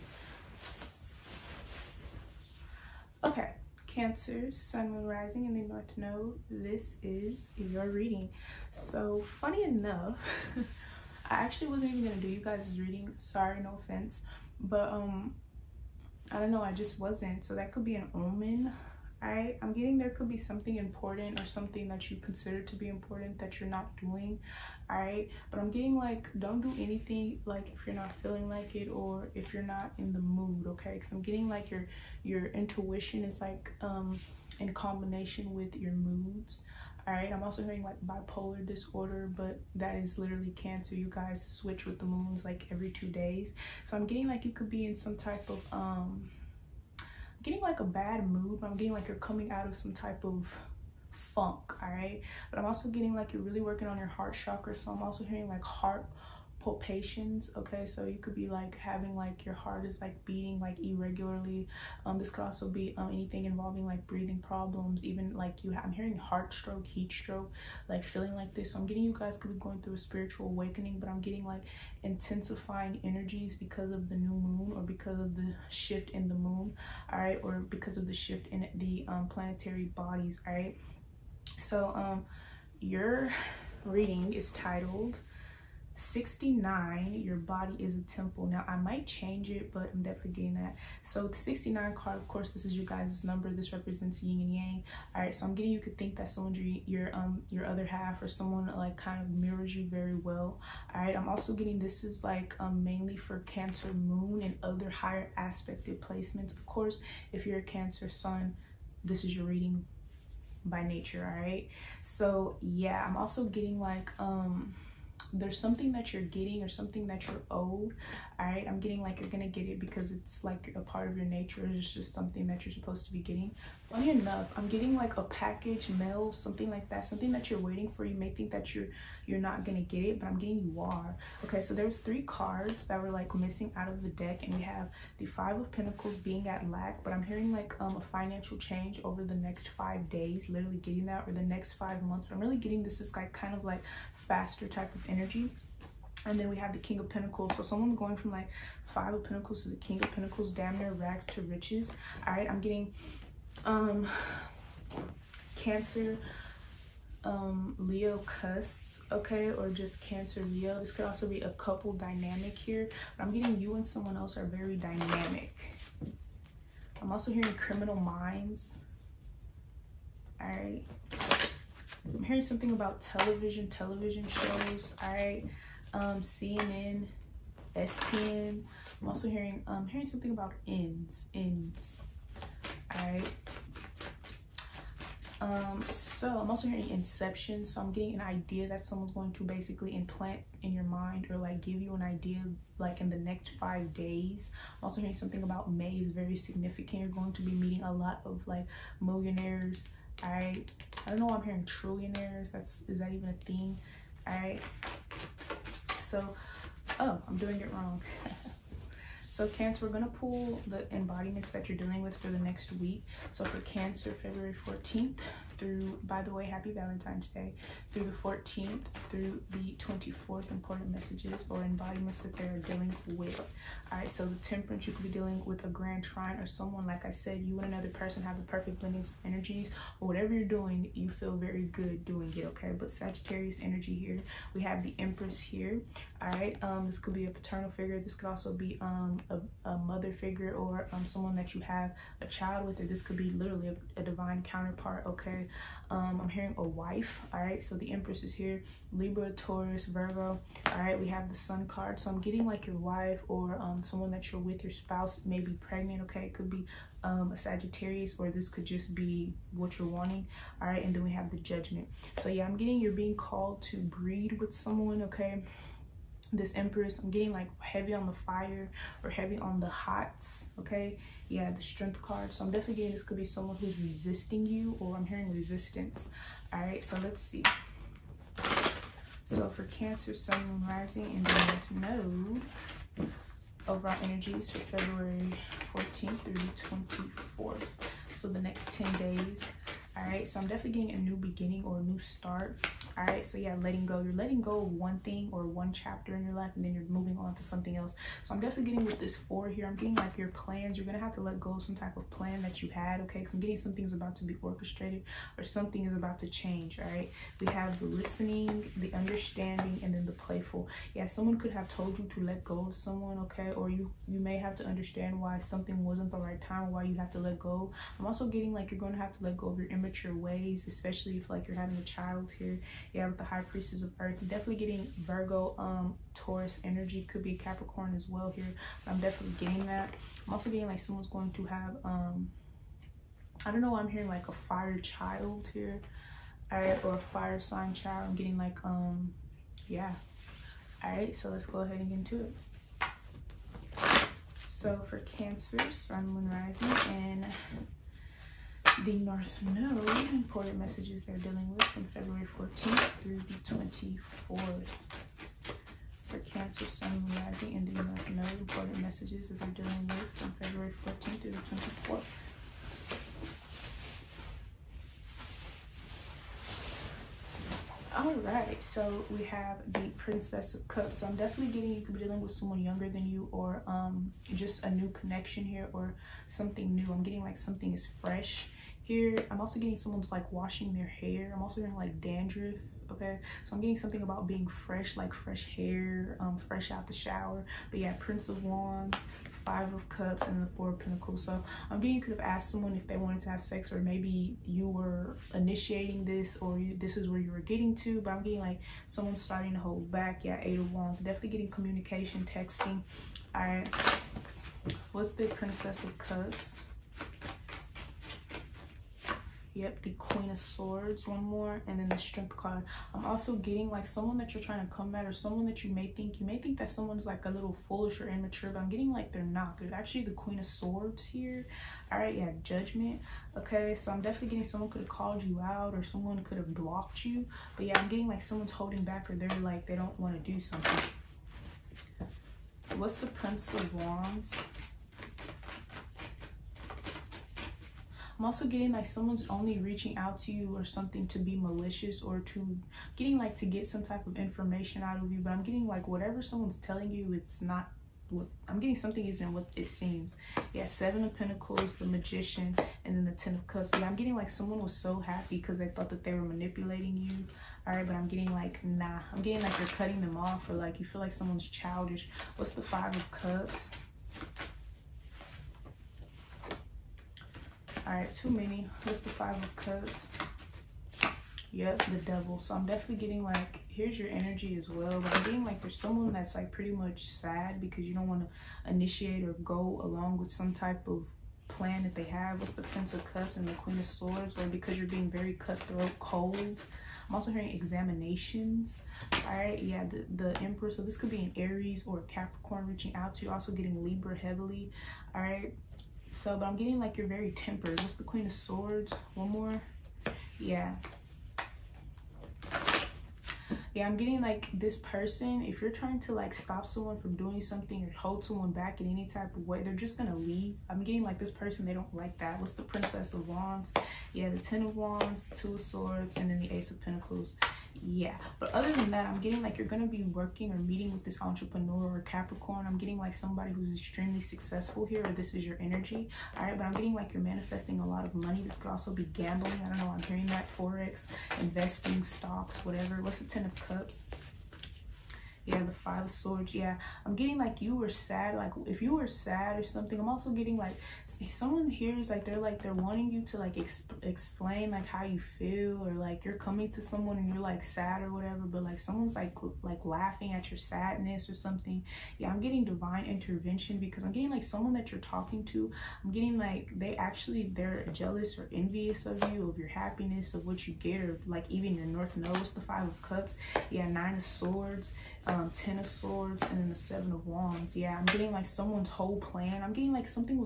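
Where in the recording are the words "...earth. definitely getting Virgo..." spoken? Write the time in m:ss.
5:23.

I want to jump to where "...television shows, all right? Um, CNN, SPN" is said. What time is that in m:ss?
2:53.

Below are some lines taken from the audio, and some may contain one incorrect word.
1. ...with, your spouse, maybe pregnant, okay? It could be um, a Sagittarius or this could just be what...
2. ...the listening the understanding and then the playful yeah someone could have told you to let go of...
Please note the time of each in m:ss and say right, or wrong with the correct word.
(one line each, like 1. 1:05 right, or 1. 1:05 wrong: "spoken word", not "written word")
1. 4:14 right
2. 5:07 right.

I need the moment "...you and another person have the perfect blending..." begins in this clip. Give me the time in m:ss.
3:47.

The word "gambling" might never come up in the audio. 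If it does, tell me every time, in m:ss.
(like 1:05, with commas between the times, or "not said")
8:49.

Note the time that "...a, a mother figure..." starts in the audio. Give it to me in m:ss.
3:59.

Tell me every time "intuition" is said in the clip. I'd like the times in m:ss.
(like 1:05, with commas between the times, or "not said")
0:32.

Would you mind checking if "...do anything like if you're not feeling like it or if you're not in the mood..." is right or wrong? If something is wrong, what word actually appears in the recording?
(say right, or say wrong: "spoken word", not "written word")
right.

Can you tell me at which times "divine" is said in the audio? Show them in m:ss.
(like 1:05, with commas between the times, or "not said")
4:04, 9:12.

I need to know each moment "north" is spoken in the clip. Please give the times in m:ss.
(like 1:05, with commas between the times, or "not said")
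0:05, 5:48, 5:57, 9:21.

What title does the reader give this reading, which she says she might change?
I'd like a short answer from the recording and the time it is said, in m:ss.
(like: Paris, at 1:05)
Your body is a temple, at 1:27.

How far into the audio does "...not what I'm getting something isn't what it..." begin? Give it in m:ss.
7:27.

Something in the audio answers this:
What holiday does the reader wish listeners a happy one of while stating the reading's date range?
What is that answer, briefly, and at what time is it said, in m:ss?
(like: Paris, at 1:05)
Valentine's Day, at 3:36.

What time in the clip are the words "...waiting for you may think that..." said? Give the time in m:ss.
2:07.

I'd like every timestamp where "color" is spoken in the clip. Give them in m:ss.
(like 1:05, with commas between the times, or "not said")
not said.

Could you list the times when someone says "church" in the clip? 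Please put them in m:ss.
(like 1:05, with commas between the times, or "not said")
not said.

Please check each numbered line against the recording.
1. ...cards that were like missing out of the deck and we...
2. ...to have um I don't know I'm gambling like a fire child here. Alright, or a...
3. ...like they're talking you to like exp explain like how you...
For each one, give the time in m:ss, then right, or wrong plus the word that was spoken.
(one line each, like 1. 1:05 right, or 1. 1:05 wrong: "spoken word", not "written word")
1. 2:12 right
2. 5:31 wrong: "hearing", not "gambling"
3. 9:02 wrong: "wanting", not "talking".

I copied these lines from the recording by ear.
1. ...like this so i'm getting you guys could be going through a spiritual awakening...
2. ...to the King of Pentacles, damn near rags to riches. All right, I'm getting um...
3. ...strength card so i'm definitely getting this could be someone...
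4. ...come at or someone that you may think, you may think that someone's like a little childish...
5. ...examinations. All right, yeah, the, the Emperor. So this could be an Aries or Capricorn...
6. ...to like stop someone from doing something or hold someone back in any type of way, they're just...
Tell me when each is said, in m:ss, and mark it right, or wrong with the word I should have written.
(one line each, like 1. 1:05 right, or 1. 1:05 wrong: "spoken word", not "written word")
1. 1:08 right
2. 2:29 right
3. 4:31 right
4. 6:54 wrong: "foolish", not "childish"
5. 8:07 right
6. 8:26 right.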